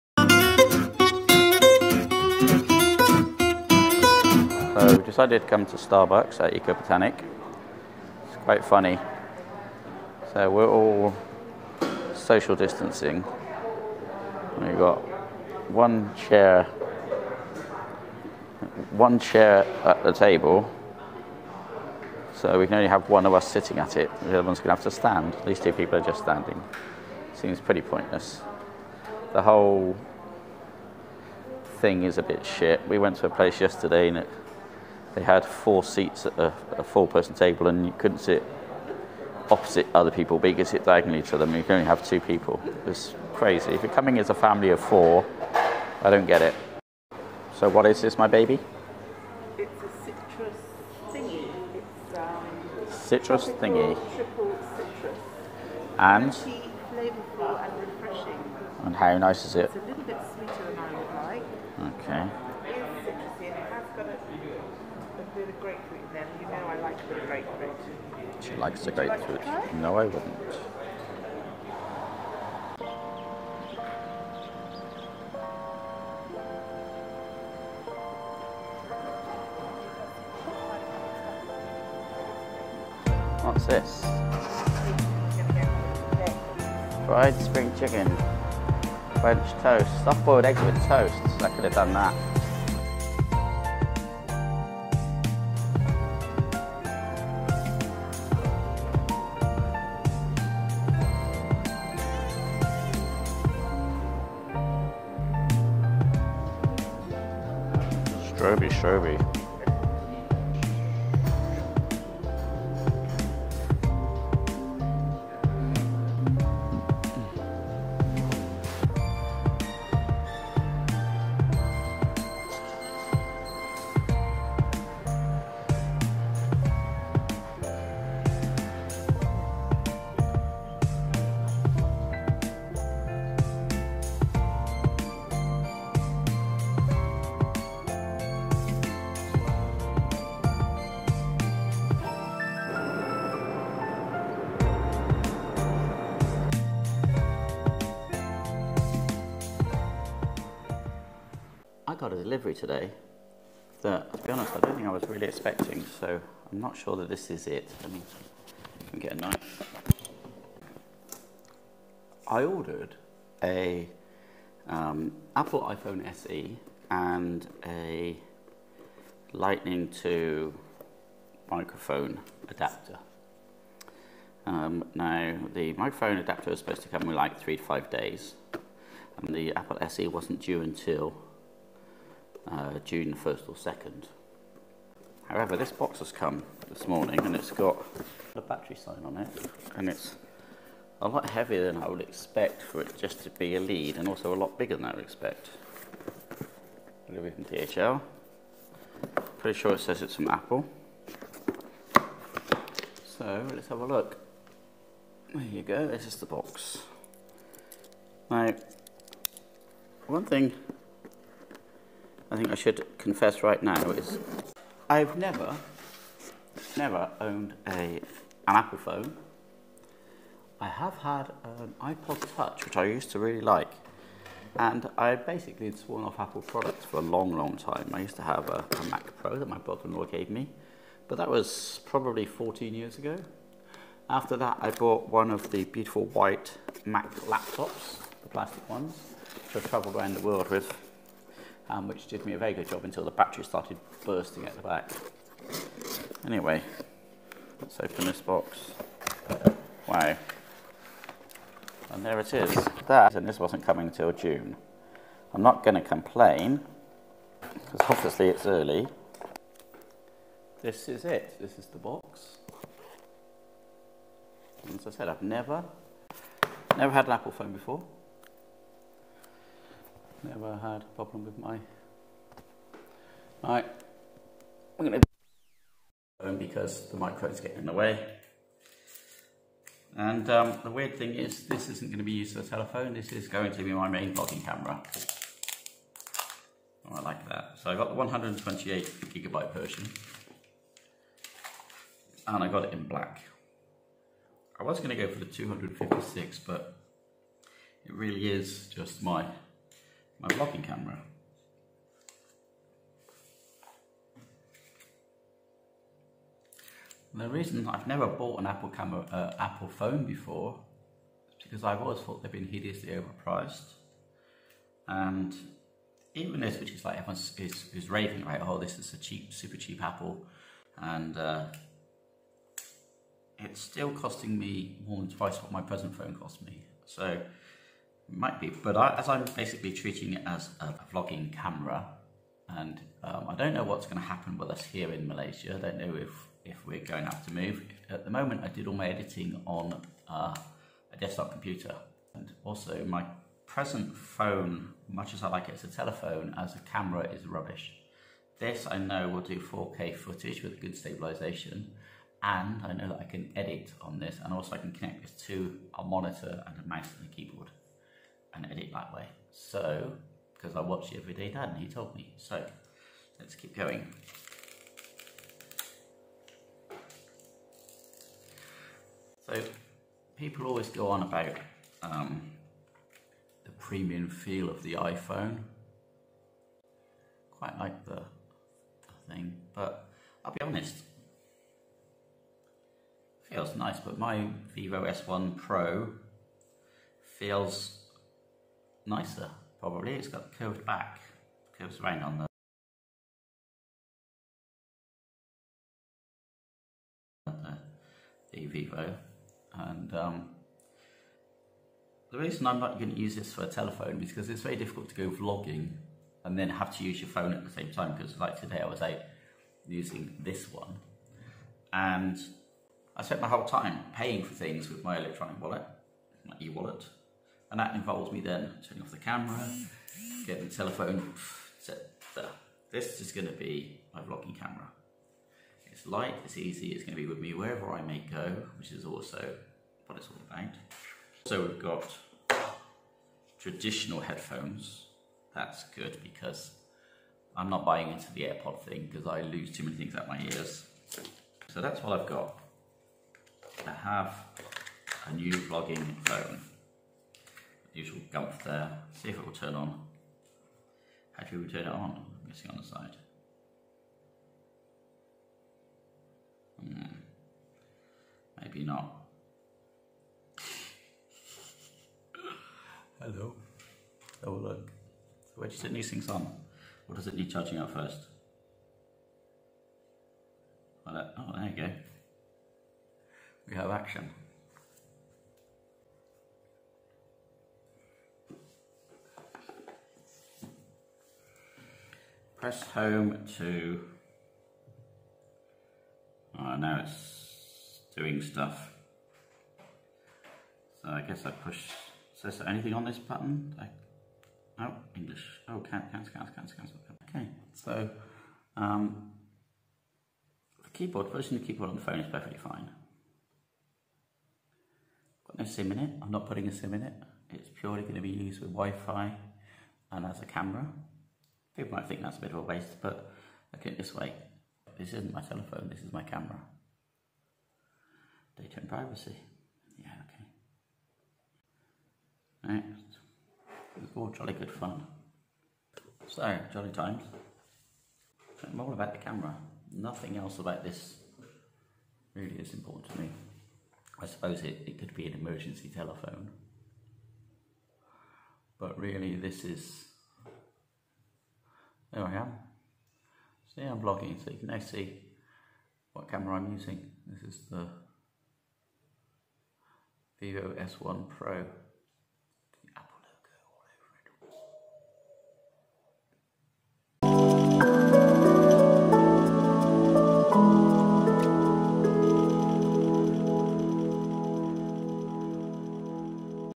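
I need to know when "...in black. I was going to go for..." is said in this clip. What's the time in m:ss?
4:52.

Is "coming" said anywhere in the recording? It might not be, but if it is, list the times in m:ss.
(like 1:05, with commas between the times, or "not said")
0:43, 4:13.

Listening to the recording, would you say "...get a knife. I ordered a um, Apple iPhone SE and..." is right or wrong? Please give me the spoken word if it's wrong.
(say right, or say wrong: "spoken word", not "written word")
right.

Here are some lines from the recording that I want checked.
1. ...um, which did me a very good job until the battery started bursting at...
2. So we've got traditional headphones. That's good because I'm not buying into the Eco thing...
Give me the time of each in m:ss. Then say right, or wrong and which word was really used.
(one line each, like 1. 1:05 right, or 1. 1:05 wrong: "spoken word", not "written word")
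1. 4:01 right
2. 7:11 wrong: "AirPod", not "Eco".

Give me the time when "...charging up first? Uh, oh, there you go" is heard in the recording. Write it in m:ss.
7:47.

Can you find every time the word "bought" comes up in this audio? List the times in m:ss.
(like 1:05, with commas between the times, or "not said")
3:54, 5:08.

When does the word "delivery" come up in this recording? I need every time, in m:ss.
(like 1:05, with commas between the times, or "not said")
2:32.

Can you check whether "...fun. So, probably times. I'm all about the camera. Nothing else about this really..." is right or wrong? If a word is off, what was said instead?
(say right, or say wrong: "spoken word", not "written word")
wrong: "jolly", not "probably".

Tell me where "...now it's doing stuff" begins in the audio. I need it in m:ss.
8:06.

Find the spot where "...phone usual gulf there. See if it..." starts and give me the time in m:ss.
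7:26.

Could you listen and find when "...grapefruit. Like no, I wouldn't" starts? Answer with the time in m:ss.
1:08.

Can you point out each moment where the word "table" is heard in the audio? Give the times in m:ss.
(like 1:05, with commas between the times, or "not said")
0:20, 0:37.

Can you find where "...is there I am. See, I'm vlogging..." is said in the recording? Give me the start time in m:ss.
8:59.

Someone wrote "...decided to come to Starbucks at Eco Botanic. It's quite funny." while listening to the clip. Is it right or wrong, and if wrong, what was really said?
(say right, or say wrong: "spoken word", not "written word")
right.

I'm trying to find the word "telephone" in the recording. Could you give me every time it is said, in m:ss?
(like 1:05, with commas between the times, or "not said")
4:42, 5:45, 6:43, 7:00, 8:35, 8:55.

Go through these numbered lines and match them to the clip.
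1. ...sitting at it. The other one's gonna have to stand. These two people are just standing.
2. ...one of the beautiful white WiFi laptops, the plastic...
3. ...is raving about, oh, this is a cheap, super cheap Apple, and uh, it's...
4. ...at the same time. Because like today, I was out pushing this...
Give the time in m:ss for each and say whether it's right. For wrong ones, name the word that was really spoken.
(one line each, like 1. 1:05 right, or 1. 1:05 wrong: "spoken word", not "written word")
1. 0:23 right
2. 3:55 wrong: "Mac", not "WiFi"
3. 5:17 right
4. 6:47 wrong: "using", not "pushing".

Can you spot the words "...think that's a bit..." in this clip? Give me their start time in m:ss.
8:31.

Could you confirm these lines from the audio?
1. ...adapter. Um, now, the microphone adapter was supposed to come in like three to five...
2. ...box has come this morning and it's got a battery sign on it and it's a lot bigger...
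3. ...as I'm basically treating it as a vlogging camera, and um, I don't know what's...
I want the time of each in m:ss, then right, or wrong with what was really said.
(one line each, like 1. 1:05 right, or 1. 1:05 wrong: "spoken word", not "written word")
1. 2:52 right
2. 3:05 wrong: "heavier", not "bigger"
3. 5:28 right.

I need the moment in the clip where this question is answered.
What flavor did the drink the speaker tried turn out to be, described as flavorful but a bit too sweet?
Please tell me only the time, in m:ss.
0:54.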